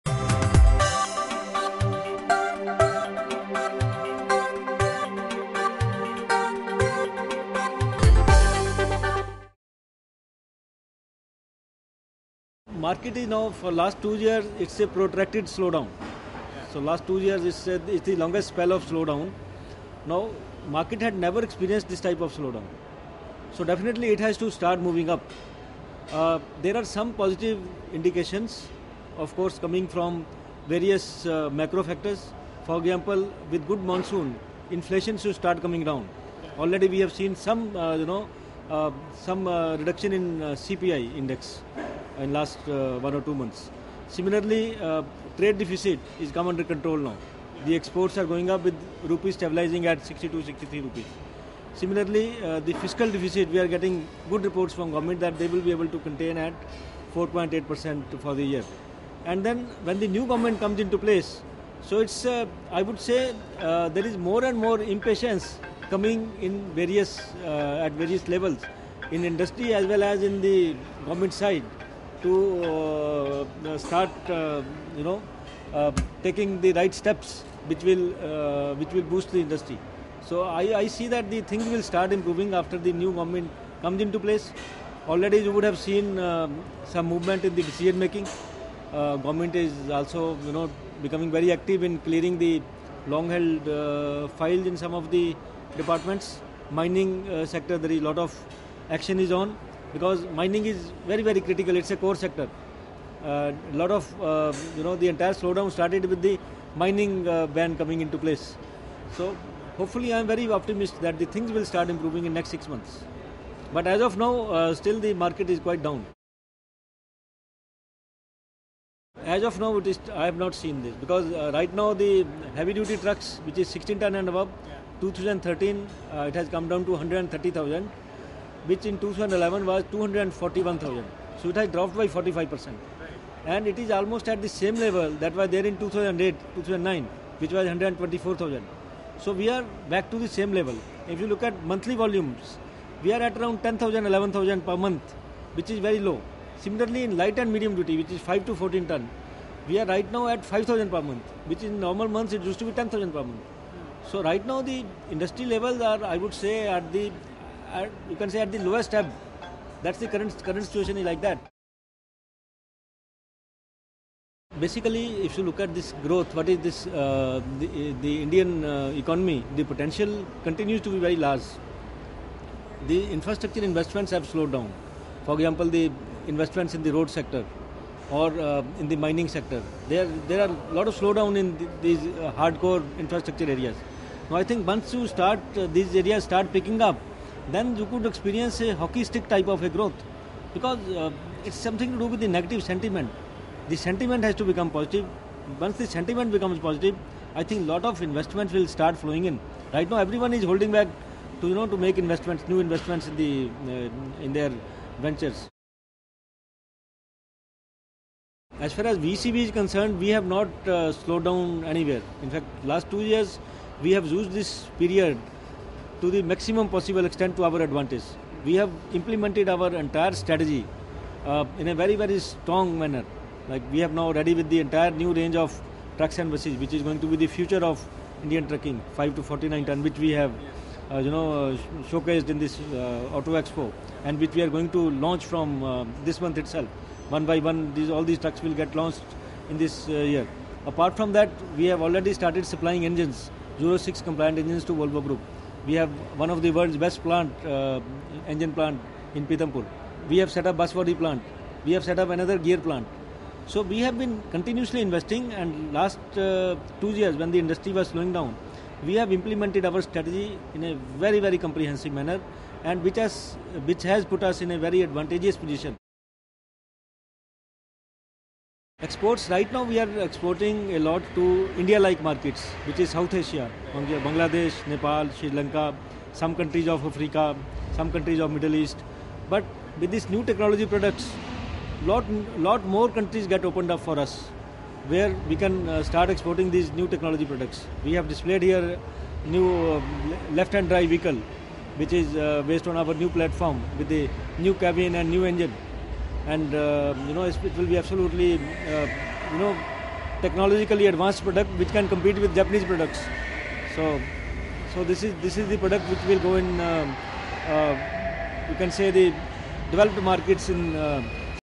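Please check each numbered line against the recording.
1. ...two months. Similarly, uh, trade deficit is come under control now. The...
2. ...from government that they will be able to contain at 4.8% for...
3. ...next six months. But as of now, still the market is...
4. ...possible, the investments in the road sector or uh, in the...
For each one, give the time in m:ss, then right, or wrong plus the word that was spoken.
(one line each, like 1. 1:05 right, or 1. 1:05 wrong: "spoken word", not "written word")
1. 0:43 right
2. 0:54 right
3. 1:52 right
4. 2:55 wrong: "example", not "possible".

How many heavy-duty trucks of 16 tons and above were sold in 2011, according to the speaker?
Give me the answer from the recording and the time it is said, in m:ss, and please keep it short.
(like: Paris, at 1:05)
241,000, at 2:09.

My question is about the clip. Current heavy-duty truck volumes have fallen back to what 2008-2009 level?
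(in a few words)
124,000.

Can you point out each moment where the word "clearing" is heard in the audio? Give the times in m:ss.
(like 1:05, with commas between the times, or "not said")
1:31.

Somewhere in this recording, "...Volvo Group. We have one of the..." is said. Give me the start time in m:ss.
4:04.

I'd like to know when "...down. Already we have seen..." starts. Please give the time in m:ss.
0:35.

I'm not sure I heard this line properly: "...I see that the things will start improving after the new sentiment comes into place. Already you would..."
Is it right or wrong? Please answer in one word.
wrong.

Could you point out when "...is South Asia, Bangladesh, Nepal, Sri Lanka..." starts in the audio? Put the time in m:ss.
4:32.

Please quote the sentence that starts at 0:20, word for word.
Now market had never experienced this type of slowdown.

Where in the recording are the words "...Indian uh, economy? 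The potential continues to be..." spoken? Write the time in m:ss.
2:48.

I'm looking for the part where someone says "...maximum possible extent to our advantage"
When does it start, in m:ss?
3:36.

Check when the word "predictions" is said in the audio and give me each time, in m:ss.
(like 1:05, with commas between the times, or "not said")
not said.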